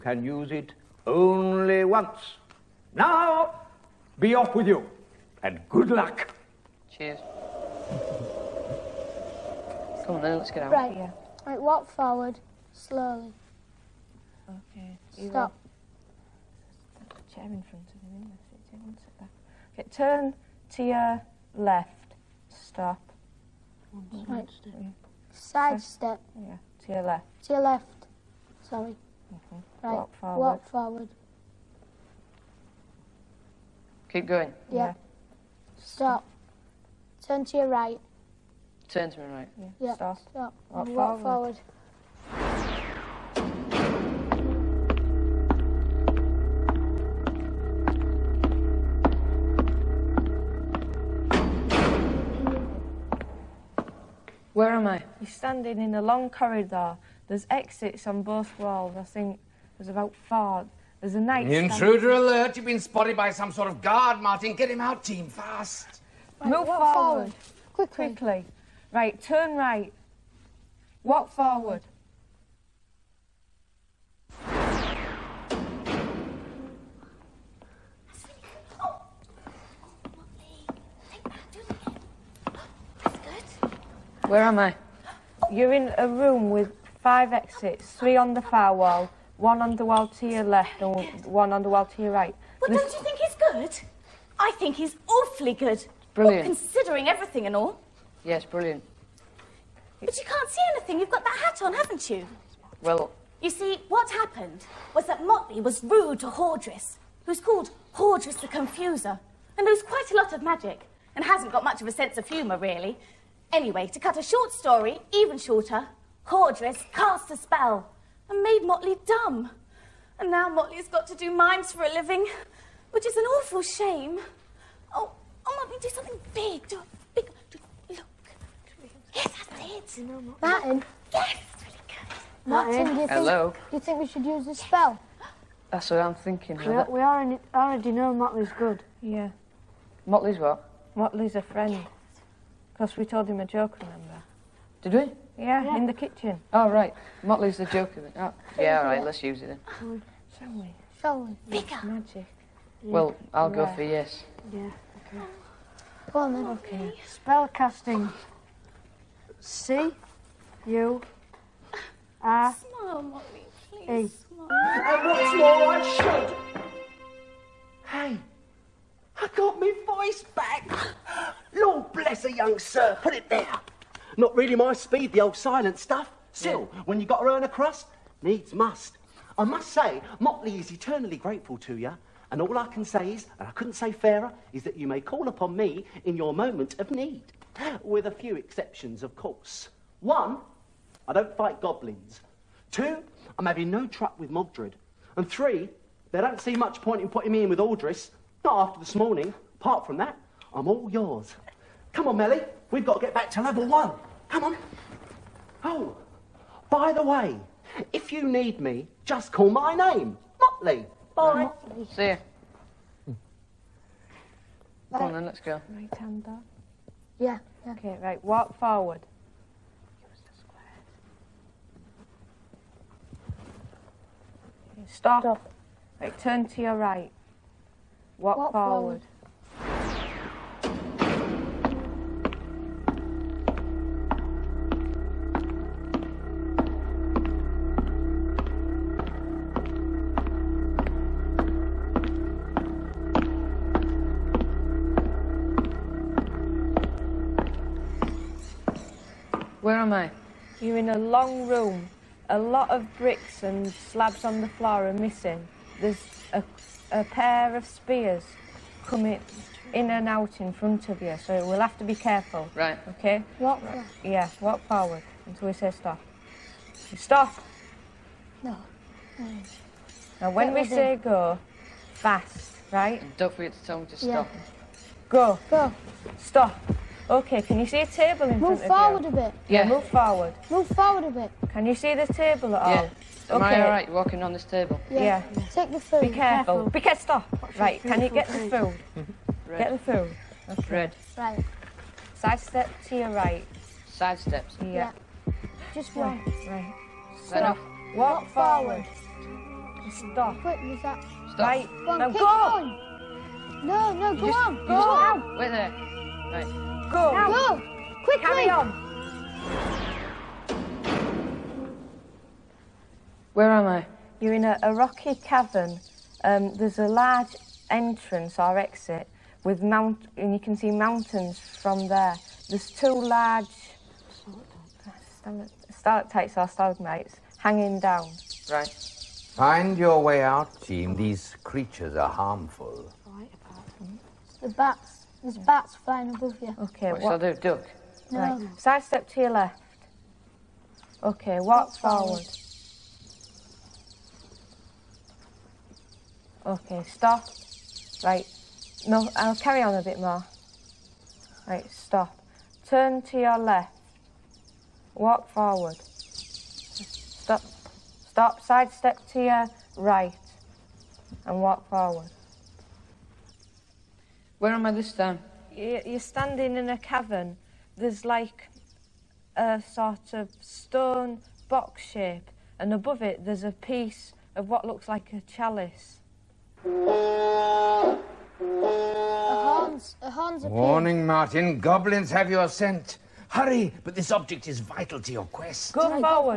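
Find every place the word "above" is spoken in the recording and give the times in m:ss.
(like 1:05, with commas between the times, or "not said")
5:36, 6:12.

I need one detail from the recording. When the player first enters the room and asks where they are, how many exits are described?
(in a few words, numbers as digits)
5.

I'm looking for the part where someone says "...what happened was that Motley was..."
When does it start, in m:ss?
1:43.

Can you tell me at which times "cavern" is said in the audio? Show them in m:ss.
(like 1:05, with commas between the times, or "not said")
5:15, 6:06.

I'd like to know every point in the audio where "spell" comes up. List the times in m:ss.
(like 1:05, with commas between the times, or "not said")
1:57, 2:14, 2:37.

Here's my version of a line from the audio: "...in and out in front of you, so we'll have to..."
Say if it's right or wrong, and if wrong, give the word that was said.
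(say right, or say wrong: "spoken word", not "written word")
right.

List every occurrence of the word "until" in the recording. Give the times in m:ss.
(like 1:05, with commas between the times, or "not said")
4:25.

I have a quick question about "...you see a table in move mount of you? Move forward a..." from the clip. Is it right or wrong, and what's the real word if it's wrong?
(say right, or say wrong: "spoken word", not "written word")
wrong: "front", not "mount".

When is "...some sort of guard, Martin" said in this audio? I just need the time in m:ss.
1:03.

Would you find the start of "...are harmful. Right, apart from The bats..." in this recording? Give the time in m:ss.
5:31.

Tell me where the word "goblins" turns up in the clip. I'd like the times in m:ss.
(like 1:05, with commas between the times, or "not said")
3:11, 6:21.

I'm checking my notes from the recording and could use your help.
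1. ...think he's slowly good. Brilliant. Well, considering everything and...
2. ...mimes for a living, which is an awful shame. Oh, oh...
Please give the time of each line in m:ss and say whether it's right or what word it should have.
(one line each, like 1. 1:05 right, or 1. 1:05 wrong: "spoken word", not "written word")
1. 1:34 wrong: "awfully", not "slowly"
2. 2:01 right.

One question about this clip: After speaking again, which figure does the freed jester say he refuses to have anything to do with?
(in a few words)
Mogdred.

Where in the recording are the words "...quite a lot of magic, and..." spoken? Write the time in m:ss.
1:49.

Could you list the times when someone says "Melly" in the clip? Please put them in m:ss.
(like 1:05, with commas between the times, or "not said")
3:22.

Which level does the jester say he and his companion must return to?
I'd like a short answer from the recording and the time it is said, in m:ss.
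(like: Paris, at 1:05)
Level one, at 3:23.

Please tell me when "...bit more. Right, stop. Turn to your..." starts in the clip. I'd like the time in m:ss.
5:49.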